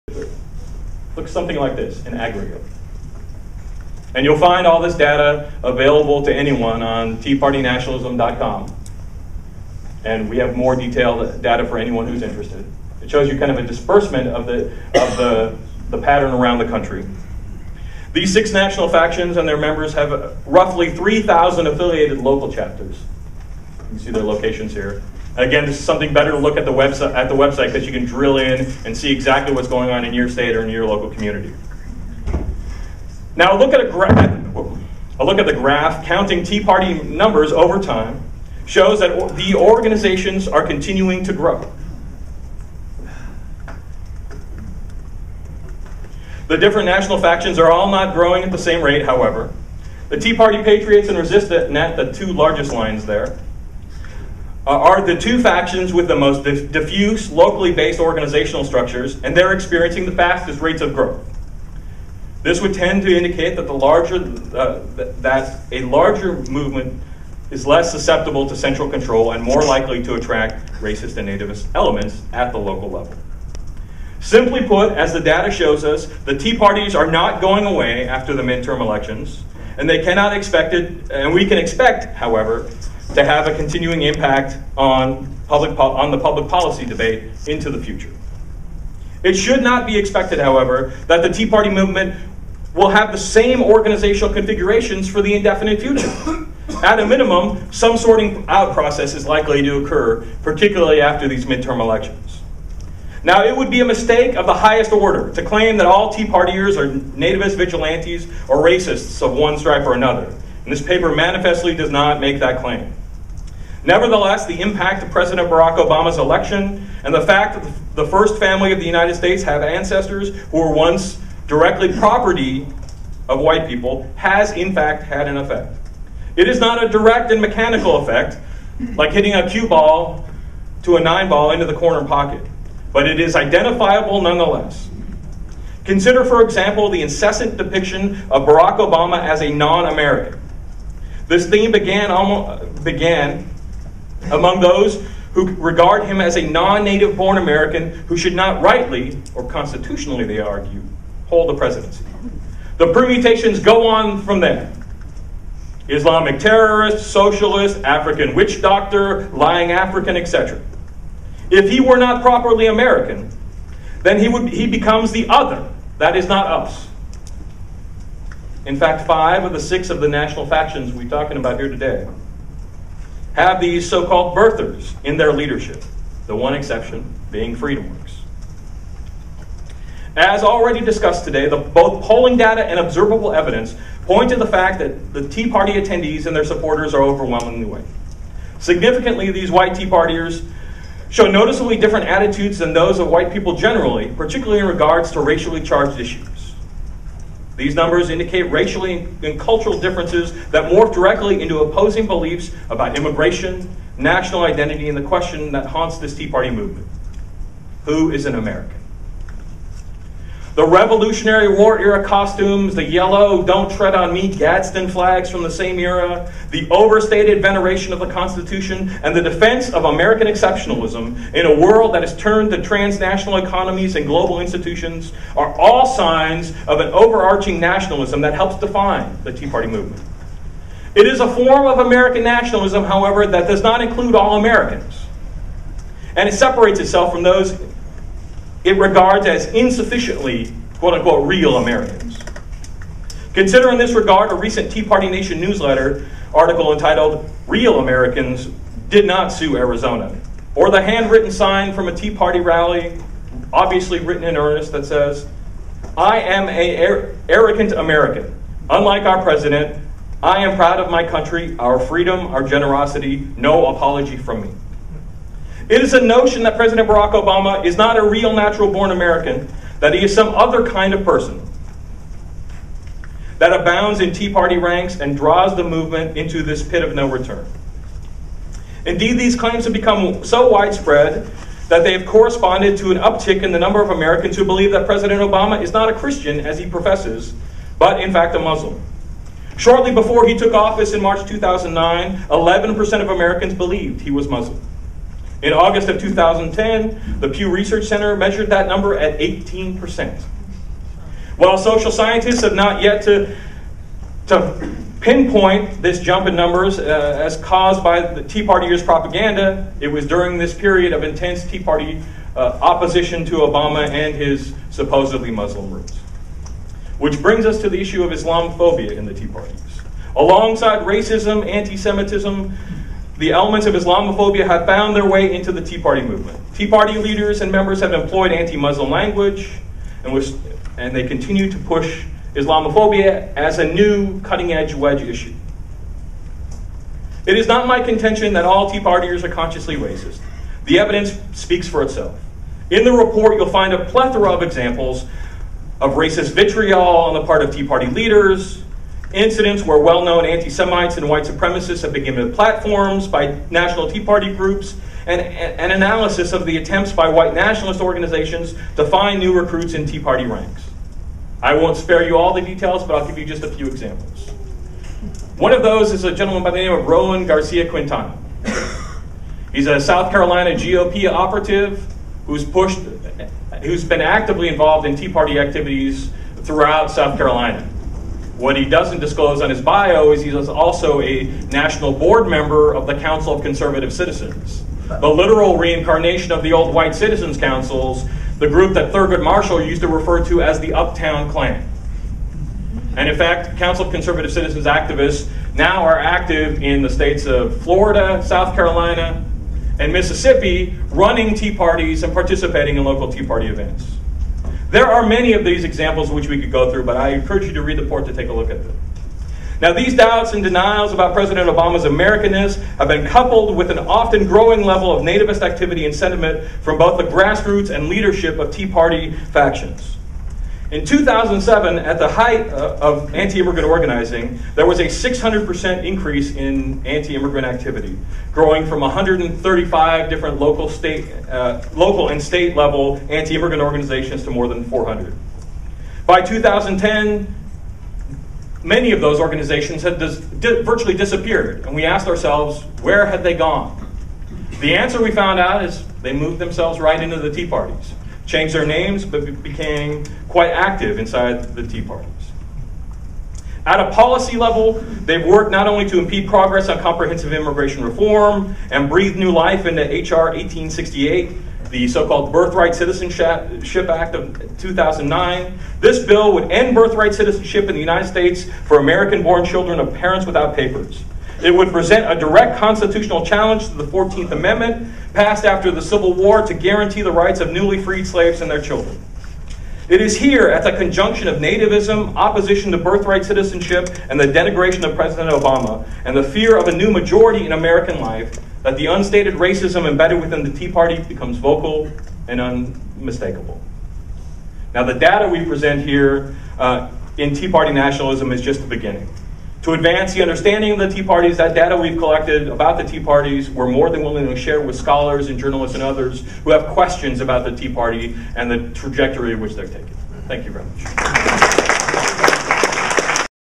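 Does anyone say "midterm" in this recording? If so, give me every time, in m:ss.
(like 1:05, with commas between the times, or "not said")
1:18, 1:41.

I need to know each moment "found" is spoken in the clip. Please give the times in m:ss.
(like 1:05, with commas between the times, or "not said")
5:24, 7:25.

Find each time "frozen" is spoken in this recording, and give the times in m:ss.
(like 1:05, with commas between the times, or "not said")
not said.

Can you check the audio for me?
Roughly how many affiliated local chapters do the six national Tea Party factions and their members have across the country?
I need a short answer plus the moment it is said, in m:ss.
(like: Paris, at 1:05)
3,000, at 0:20.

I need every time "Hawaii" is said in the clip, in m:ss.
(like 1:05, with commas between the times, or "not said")
not said.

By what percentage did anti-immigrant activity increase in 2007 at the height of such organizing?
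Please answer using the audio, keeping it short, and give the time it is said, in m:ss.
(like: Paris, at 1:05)
600%, at 7:04.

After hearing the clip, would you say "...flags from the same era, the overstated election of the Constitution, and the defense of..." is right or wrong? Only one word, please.
wrong.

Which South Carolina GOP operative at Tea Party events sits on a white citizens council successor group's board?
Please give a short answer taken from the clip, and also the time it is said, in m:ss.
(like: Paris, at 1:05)
Roland Garcia Quintana, at 6:06.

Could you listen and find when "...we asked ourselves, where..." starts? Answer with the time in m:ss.
7:21.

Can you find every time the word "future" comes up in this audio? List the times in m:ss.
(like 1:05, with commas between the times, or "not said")
1:27, 1:35.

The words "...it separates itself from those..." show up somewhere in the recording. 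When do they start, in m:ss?
3:56.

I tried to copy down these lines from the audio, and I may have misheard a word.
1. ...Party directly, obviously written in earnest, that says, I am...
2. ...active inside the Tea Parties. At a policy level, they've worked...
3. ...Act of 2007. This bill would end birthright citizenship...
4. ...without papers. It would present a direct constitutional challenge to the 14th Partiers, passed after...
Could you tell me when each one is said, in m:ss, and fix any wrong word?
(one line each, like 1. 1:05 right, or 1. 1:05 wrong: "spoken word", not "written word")
1. 4:12 wrong: "rally", not "directly"
2. 7:30 right
3. 7:43 wrong: "2009", not "2007"
4. 7:50 wrong: "Amendment", not "Partiers".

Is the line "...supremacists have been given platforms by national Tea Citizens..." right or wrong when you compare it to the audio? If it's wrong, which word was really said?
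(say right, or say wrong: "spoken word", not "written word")
wrong: "Party", not "Citizens".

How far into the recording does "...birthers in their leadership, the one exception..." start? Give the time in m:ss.
2:54.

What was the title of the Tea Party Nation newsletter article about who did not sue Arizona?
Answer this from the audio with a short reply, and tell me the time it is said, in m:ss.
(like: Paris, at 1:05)
Real Americans Did Not Sue Arizona, at 4:07.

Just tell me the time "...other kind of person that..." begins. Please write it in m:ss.
4:30.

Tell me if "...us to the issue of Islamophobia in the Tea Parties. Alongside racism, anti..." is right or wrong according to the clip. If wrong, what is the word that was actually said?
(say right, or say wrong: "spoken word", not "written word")
right.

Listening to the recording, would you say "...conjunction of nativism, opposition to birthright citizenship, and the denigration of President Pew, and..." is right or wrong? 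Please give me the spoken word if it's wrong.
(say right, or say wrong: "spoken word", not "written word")
wrong: "Obama", not "Pew".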